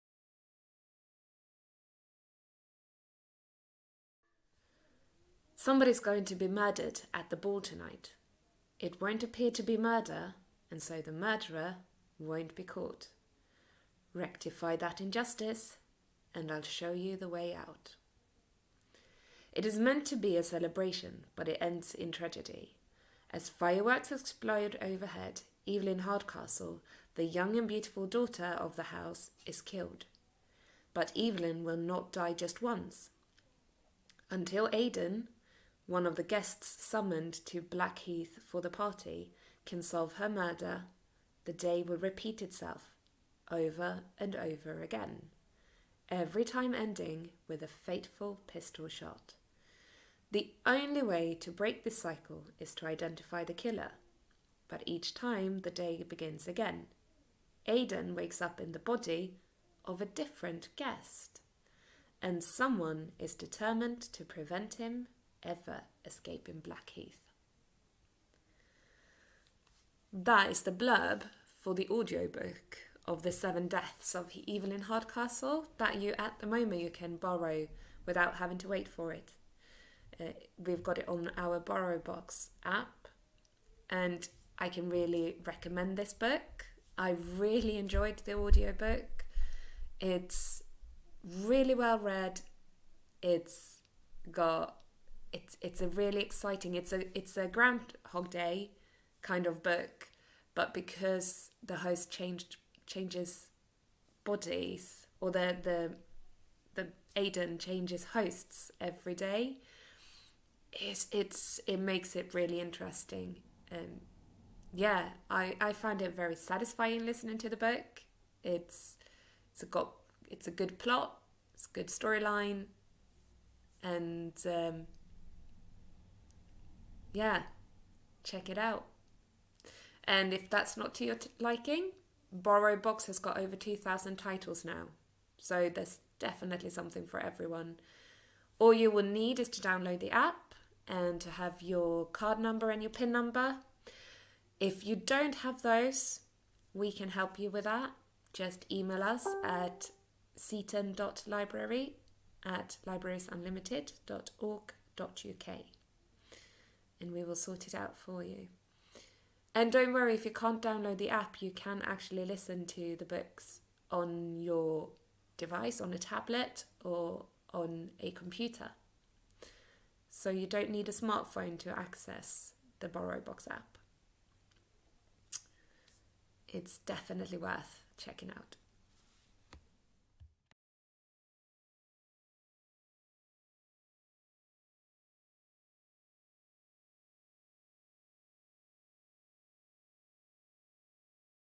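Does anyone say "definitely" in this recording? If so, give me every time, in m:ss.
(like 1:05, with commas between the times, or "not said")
2:16, 2:56.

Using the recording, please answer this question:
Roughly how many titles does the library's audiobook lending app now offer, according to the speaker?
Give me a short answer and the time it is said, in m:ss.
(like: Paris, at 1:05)
over 2,000, at 2:13.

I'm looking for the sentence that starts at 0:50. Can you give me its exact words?
The only way to break this cycle is to identify the killer, but each time the day begins again.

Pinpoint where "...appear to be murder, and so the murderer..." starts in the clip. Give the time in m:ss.
0:09.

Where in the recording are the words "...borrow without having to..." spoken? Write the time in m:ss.
1:17.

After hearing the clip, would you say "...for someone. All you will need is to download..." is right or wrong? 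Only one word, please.
wrong.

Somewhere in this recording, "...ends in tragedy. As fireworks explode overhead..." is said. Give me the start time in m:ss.
0:21.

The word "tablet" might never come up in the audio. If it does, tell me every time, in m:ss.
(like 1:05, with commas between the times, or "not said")
2:45.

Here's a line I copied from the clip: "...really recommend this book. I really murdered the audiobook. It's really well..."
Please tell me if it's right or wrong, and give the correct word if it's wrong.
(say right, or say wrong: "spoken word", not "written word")
wrong: "enjoyed", not "murdered".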